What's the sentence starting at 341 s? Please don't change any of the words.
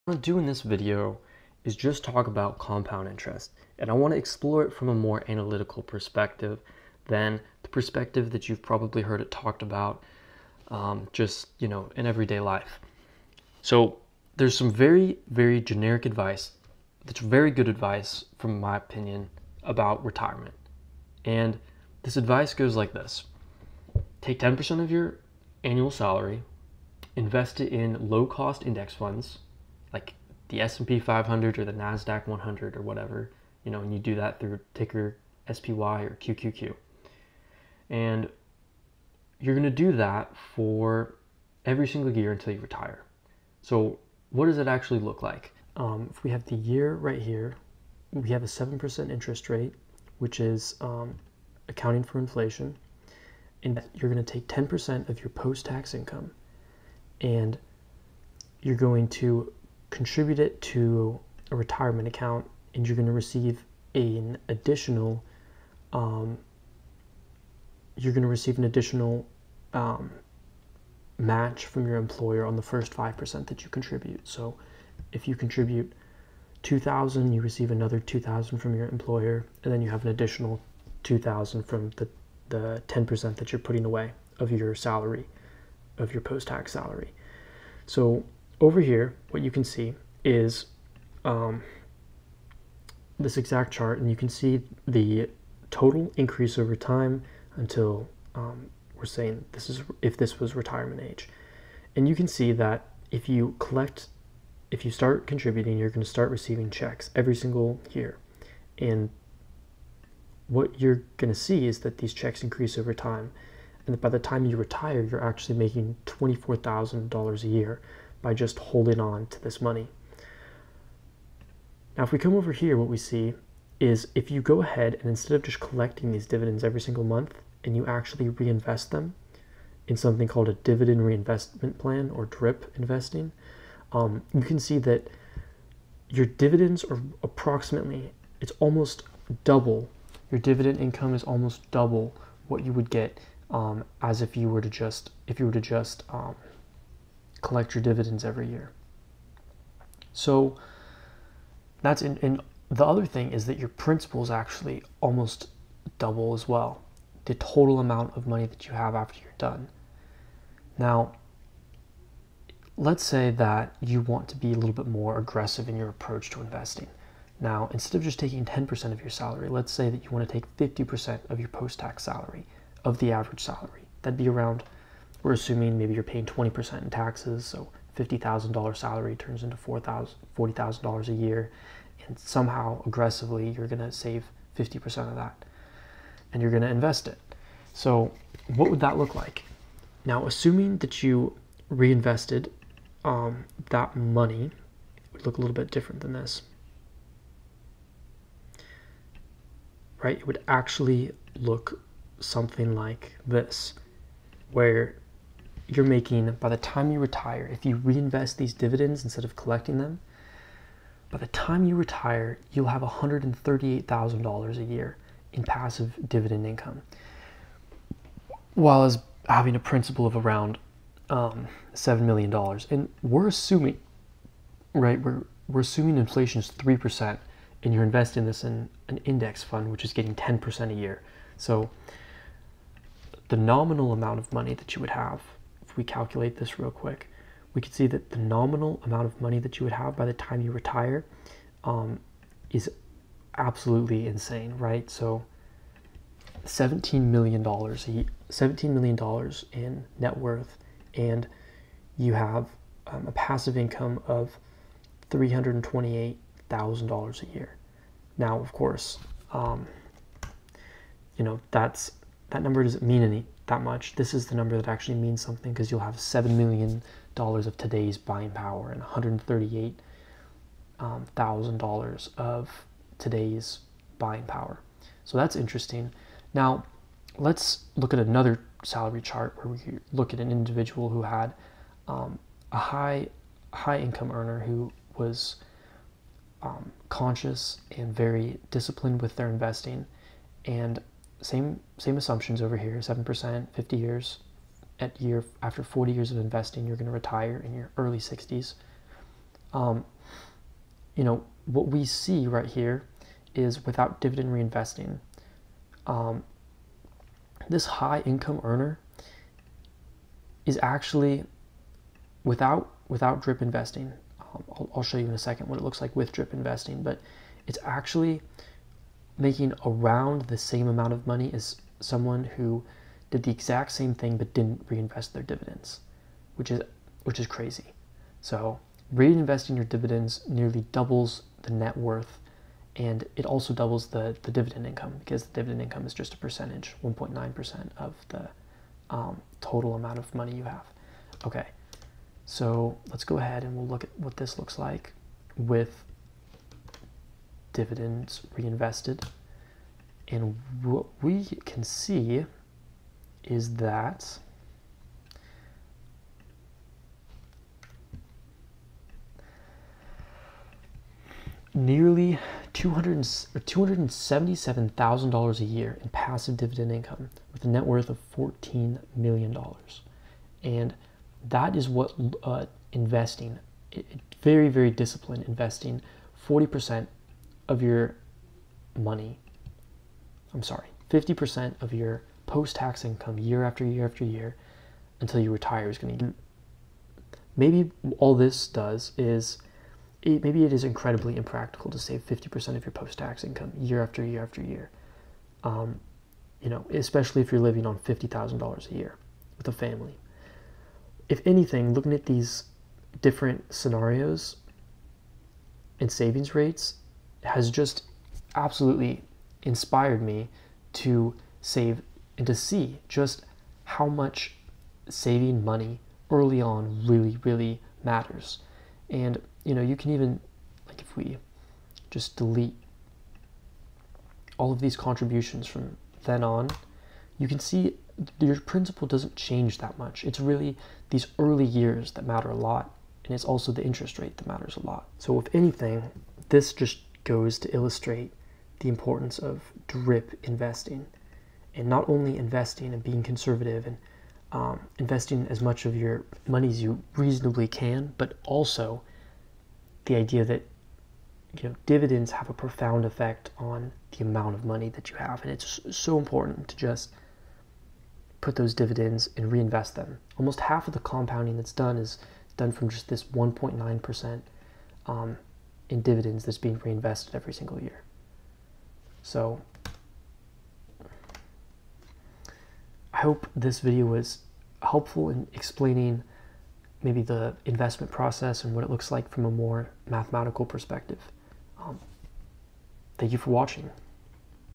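Okay, so let's go ahead and we'll look at what this looks like with dividends reinvested.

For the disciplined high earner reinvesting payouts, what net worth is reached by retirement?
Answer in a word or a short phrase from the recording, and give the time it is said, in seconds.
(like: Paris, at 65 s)
$14 million, at 368 s.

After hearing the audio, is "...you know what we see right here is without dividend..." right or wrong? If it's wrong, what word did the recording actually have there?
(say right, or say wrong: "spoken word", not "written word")
right.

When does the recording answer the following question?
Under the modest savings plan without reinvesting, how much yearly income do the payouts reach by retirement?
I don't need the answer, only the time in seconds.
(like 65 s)
116 s.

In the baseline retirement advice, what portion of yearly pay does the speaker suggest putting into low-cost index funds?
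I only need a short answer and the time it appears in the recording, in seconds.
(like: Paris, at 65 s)
10%, at 24 s.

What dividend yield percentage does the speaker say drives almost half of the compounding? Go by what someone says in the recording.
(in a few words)
1.9%.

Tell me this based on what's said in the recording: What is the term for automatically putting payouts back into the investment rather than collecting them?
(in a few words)
dividend reinvestment plan.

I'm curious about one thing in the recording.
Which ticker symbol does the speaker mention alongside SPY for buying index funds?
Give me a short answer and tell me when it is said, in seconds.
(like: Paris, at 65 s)
QQQ, at 36 s.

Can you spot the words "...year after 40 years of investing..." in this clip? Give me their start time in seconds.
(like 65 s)
294 s.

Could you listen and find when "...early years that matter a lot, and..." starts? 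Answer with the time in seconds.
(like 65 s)
431 s.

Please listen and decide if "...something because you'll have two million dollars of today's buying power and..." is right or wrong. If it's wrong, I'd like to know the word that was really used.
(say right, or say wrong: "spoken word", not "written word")
wrong: "seven", not "two".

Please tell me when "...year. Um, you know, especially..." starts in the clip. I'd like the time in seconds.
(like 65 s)
394 s.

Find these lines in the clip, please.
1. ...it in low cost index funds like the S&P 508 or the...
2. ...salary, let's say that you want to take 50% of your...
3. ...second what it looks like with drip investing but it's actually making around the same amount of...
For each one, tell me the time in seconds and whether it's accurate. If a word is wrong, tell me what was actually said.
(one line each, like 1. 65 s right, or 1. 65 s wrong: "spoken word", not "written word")
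1. 27 s wrong: "500", not "508"
2. 169 s right
3. 315 s right.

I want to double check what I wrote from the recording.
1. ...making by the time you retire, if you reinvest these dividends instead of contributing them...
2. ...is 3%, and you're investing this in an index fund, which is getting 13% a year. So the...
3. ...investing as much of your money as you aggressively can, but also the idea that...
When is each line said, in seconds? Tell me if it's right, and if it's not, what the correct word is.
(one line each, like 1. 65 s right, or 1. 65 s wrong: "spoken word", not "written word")
1. 205 s wrong: "collecting", not "contributing"
2. 226 s wrong: "10", not "13"
3. 444 s wrong: "reasonably", not "aggressively".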